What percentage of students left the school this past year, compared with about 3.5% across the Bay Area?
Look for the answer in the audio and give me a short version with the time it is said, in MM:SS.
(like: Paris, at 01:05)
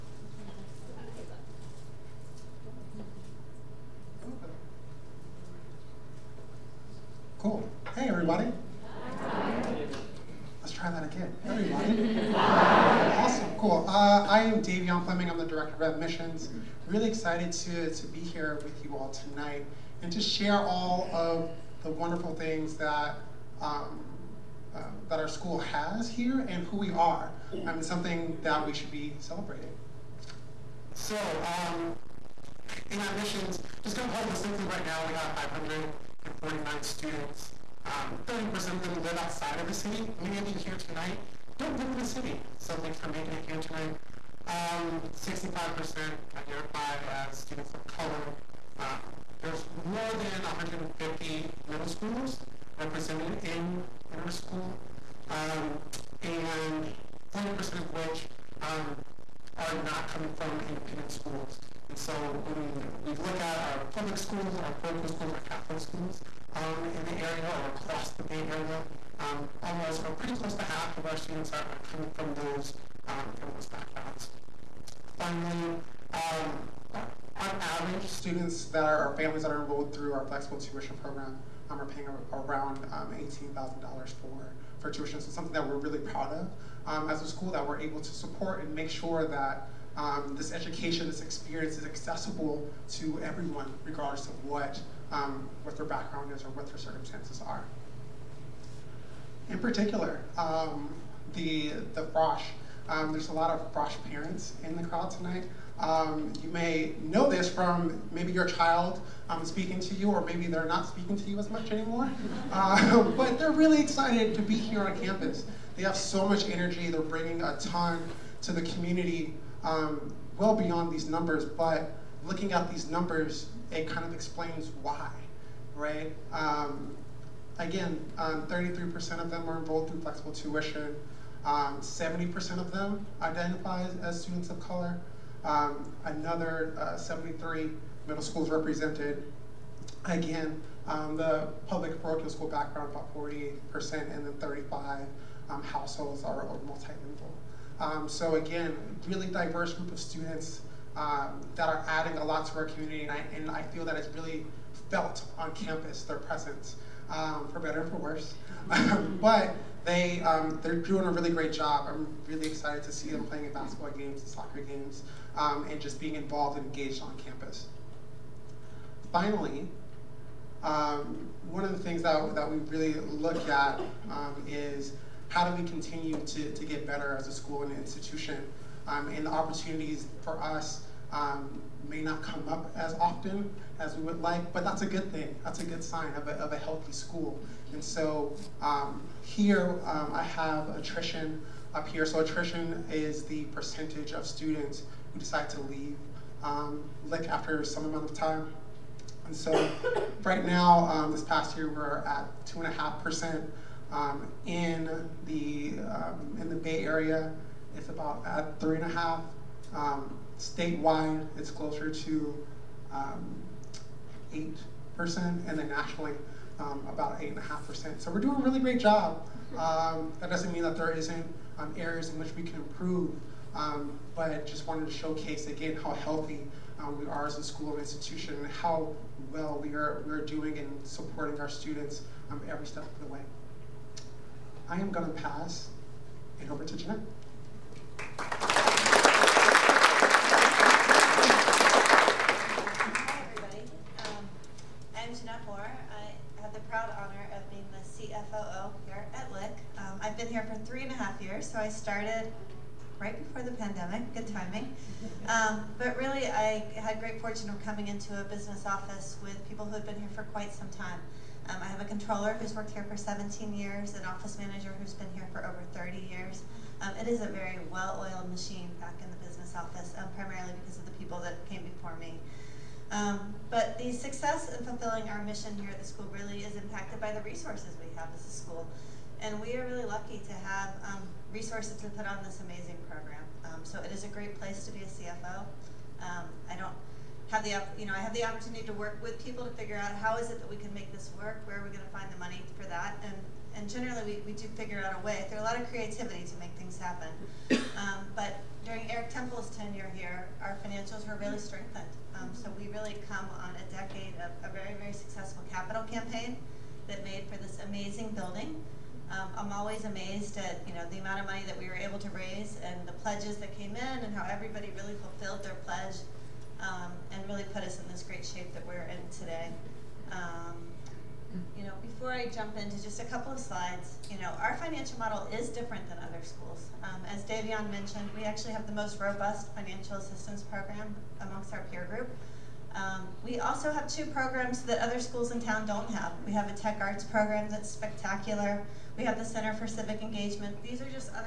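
2.5%, at 03:22.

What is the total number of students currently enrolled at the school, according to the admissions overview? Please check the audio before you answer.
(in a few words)
549.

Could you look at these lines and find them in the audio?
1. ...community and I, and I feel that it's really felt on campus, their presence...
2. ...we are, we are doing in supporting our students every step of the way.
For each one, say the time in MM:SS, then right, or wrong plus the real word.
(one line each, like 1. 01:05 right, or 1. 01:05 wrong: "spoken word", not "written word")
1. 02:32 right
2. 03:49 right.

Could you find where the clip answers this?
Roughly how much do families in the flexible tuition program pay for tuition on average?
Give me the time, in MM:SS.
01:23.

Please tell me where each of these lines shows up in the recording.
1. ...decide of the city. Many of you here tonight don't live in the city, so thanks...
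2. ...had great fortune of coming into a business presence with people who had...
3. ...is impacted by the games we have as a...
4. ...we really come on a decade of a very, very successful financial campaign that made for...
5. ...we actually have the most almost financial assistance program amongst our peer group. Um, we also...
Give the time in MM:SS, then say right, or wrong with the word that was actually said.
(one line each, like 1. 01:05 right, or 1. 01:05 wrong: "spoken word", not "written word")
1. 00:39 wrong: "outside", not "decide"
2. 04:16 wrong: "office", not "presence"
3. 04:36 wrong: "resources", not "games"
4. 05:02 wrong: "capital", not "financial"
5. 05:28 wrong: "robust", not "almost".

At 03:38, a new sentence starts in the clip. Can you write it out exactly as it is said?
So we're doing a really great job.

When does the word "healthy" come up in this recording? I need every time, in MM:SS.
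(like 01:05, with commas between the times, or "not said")
03:06, 03:45.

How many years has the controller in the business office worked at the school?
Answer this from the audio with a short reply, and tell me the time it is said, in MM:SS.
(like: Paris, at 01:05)
17, at 04:22.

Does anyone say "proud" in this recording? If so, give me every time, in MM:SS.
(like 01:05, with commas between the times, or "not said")
01:25, 04:06.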